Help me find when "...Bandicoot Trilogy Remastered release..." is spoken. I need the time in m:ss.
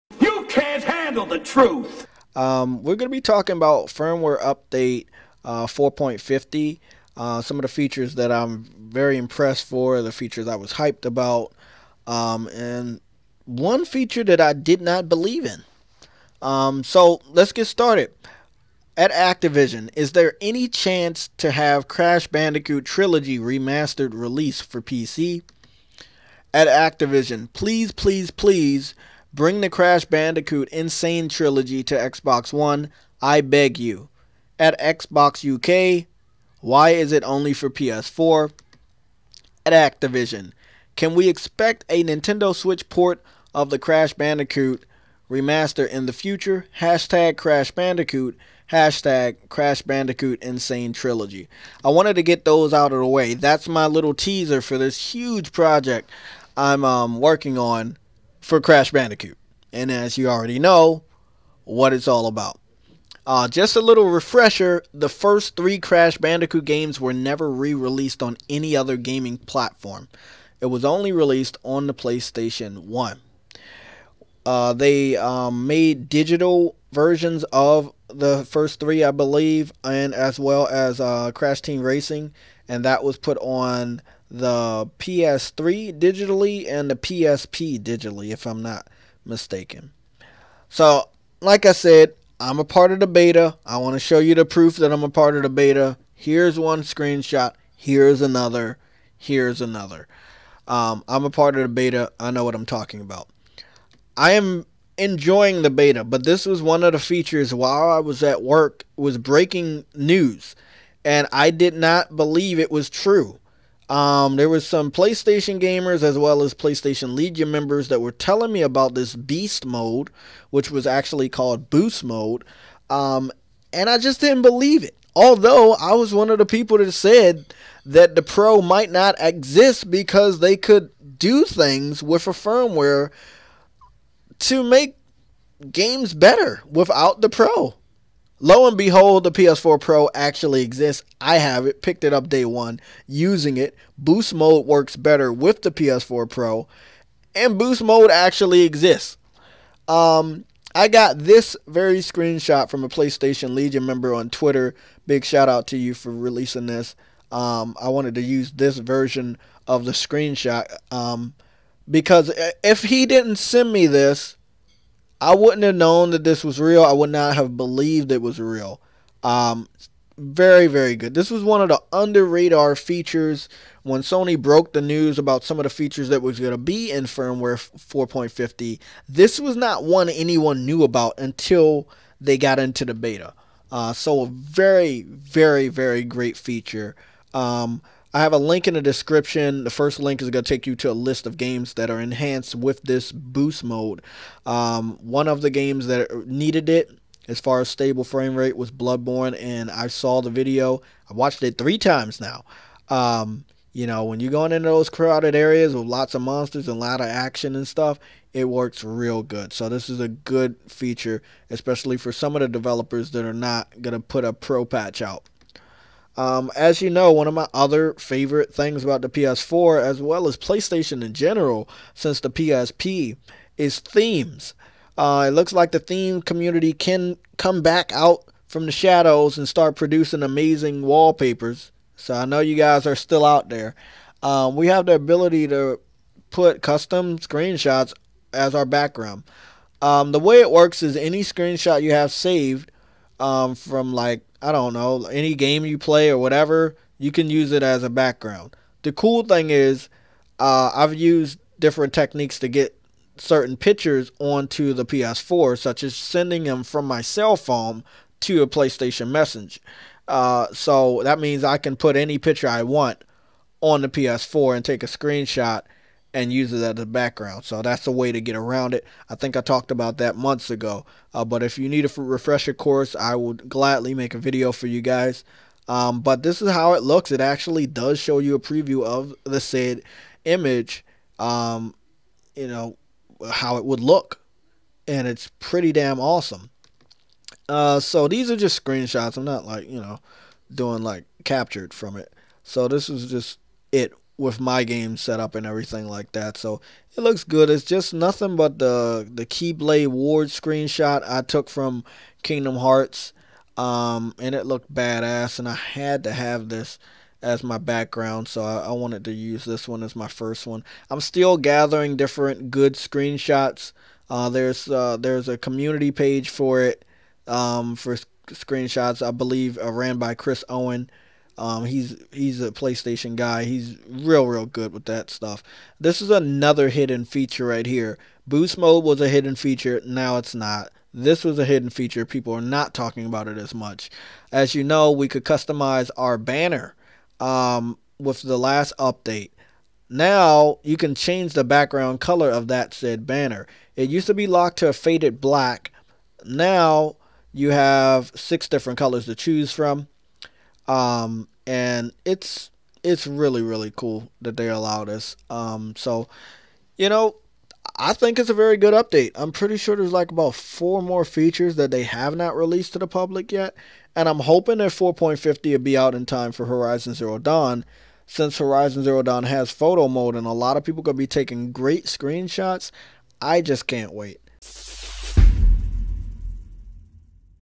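0:22.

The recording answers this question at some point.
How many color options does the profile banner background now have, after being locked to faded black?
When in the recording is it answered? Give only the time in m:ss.
5:48.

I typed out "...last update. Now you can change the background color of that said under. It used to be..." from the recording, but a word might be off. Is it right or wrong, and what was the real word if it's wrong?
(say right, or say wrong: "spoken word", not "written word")
wrong: "banner", not "under".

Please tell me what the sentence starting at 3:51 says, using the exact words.
So I know you guys are still out there.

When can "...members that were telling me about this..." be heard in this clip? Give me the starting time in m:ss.
1:57.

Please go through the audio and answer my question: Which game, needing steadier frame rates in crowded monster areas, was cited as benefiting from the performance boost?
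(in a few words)
Bloodborne.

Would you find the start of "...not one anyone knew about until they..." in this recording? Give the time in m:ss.
2:59.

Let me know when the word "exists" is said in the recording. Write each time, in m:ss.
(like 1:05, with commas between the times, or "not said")
2:09, 2:20, 2:28.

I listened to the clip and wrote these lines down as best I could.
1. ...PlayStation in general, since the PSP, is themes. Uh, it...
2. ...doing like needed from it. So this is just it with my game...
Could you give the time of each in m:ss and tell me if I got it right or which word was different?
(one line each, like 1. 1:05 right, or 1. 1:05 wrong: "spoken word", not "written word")
1. 3:40 right
2. 4:50 wrong: "captured", not "needed".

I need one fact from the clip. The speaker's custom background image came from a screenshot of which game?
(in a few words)
Kingdom Hearts.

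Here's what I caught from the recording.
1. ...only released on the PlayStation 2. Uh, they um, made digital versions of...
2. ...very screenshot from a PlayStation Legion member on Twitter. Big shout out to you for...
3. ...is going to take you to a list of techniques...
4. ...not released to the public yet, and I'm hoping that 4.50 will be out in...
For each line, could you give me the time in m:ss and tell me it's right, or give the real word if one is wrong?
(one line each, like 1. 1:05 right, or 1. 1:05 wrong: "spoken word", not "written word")
1. 1:10 wrong: "1", not "2"
2. 2:31 right
3. 3:10 wrong: "games", not "techniques"
4. 6:02 right.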